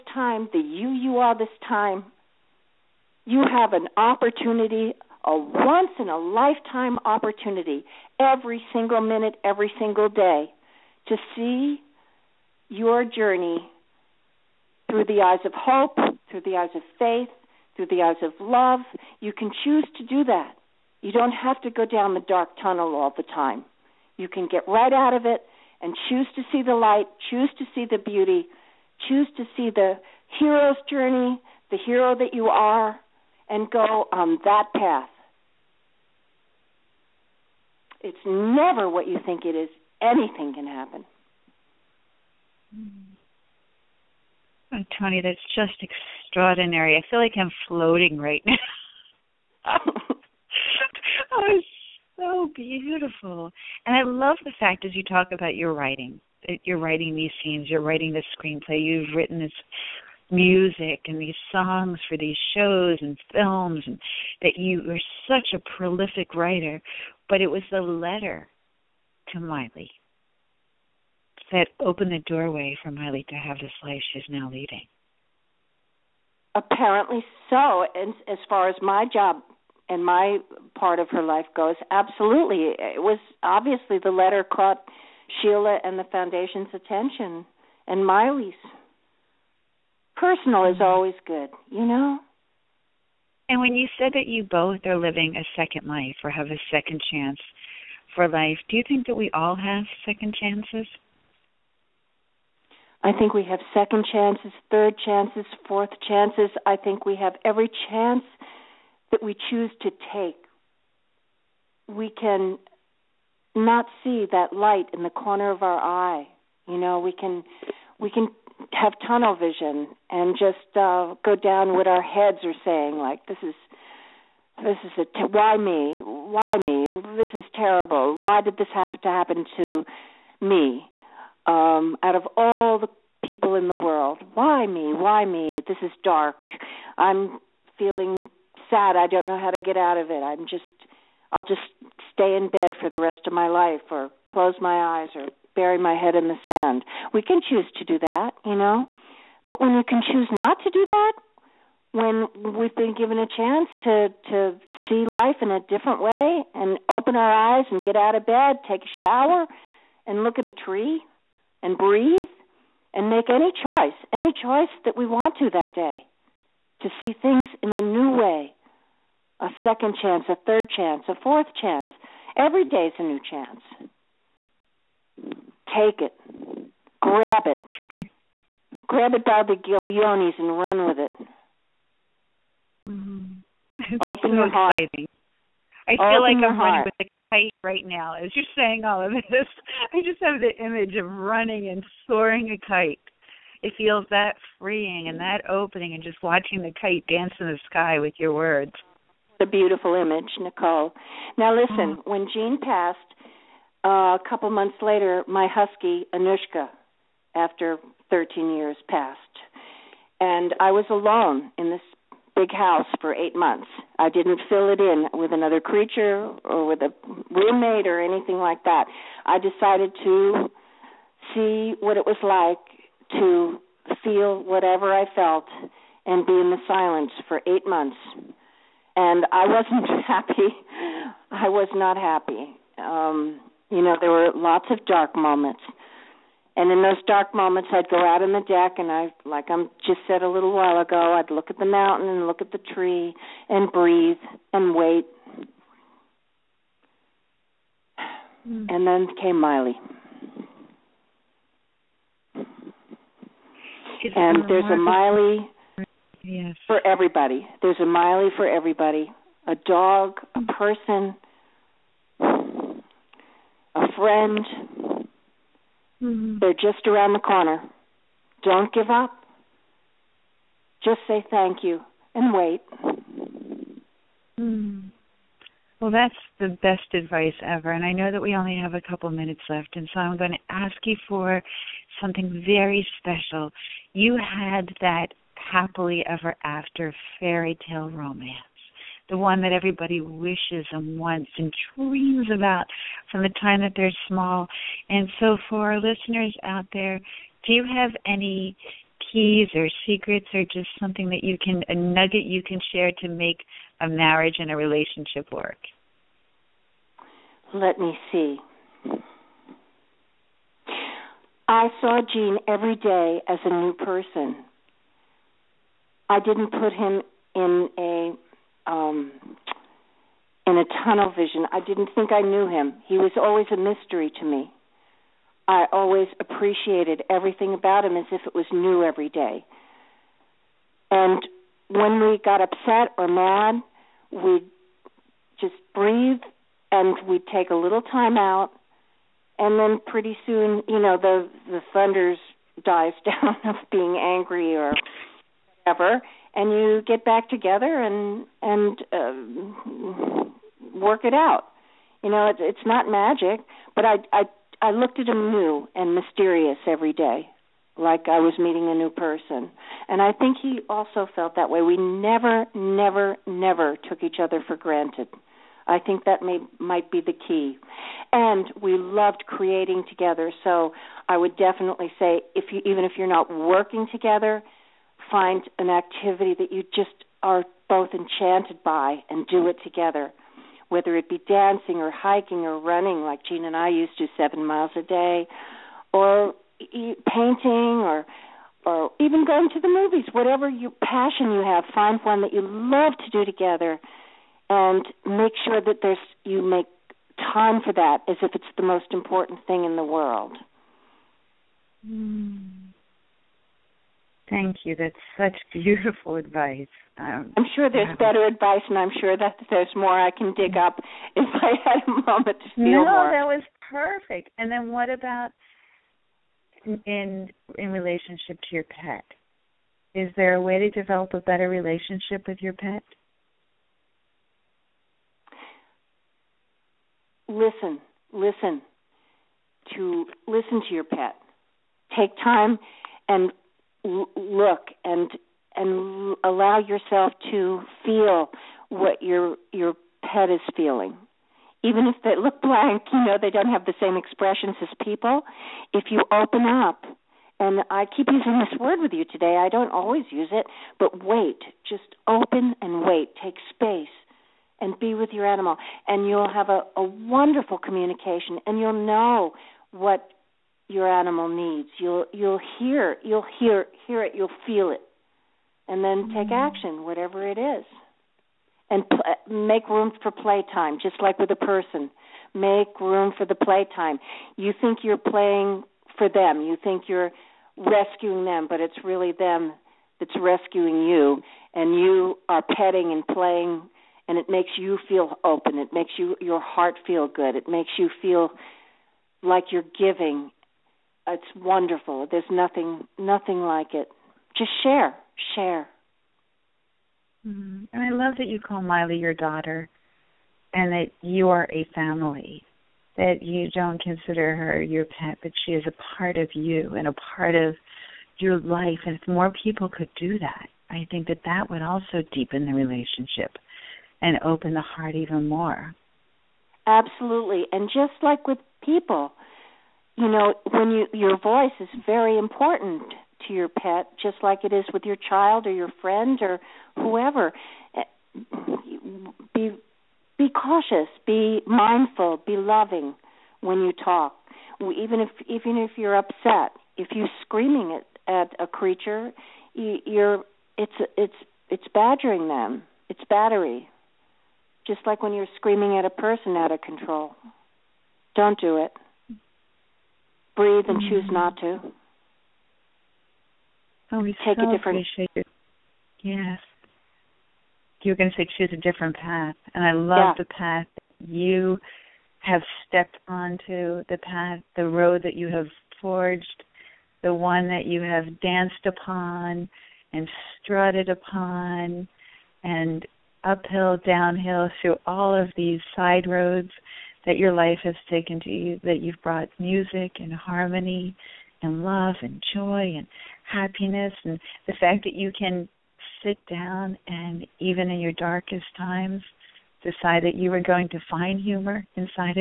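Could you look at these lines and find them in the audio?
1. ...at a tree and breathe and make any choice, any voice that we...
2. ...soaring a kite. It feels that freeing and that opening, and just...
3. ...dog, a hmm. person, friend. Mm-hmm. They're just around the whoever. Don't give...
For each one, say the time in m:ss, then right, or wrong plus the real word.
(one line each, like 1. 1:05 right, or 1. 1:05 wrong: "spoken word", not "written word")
1. 2:40 wrong: "choice", not "voice"
2. 3:12 right
3. 4:19 wrong: "corner", not "whoever".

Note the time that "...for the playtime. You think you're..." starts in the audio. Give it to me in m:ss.
7:53.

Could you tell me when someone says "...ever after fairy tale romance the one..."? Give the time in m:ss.
4:46.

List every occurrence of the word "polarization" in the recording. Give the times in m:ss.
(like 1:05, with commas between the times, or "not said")
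not said.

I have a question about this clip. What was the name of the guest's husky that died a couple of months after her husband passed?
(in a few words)
Anushka.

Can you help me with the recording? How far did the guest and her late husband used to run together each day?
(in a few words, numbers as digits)
Seven miles.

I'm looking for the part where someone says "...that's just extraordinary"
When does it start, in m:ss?
0:45.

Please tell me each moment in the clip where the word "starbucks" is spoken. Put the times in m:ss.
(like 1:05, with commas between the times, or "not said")
not said.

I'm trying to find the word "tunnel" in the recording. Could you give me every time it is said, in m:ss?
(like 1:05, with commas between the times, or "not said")
0:22, 1:59, 5:20.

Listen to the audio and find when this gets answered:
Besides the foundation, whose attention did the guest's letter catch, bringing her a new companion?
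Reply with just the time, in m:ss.
1:25.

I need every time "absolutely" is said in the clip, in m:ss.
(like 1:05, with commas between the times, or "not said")
1:21, 8:36.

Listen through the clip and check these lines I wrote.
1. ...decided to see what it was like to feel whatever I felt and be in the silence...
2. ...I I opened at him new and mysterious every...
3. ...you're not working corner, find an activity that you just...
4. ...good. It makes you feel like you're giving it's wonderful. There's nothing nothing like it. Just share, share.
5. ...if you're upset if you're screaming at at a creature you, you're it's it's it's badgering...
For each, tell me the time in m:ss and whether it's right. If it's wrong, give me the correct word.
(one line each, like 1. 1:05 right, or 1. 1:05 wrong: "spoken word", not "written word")
1. 3:39 right
2. 5:54 wrong: "looked", not "opened"
3. 6:12 wrong: "together", not "corner"
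4. 8:07 right
5. 8:55 right.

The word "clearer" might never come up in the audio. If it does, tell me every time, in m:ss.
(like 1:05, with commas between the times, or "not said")
not said.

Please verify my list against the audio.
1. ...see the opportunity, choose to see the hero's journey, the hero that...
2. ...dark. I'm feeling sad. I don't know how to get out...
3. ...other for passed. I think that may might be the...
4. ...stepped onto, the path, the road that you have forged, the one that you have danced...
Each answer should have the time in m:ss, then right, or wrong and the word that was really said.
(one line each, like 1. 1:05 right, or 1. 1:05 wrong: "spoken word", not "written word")
1. 0:27 wrong: "beauty", not "opportunity"
2. 2:16 right
3. 6:04 wrong: "granted", not "passed"
4. 9:22 right.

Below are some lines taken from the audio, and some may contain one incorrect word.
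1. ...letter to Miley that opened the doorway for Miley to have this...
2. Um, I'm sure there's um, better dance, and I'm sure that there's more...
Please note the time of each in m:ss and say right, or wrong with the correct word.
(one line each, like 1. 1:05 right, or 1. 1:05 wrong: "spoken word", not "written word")
1. 1:07 right
2. 6:46 wrong: "advice", not "dance".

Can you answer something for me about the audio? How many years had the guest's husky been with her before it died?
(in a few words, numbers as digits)
13.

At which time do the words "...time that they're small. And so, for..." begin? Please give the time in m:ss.
4:53.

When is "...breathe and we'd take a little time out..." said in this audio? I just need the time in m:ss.
5:35.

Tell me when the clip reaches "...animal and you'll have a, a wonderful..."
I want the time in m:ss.
7:35.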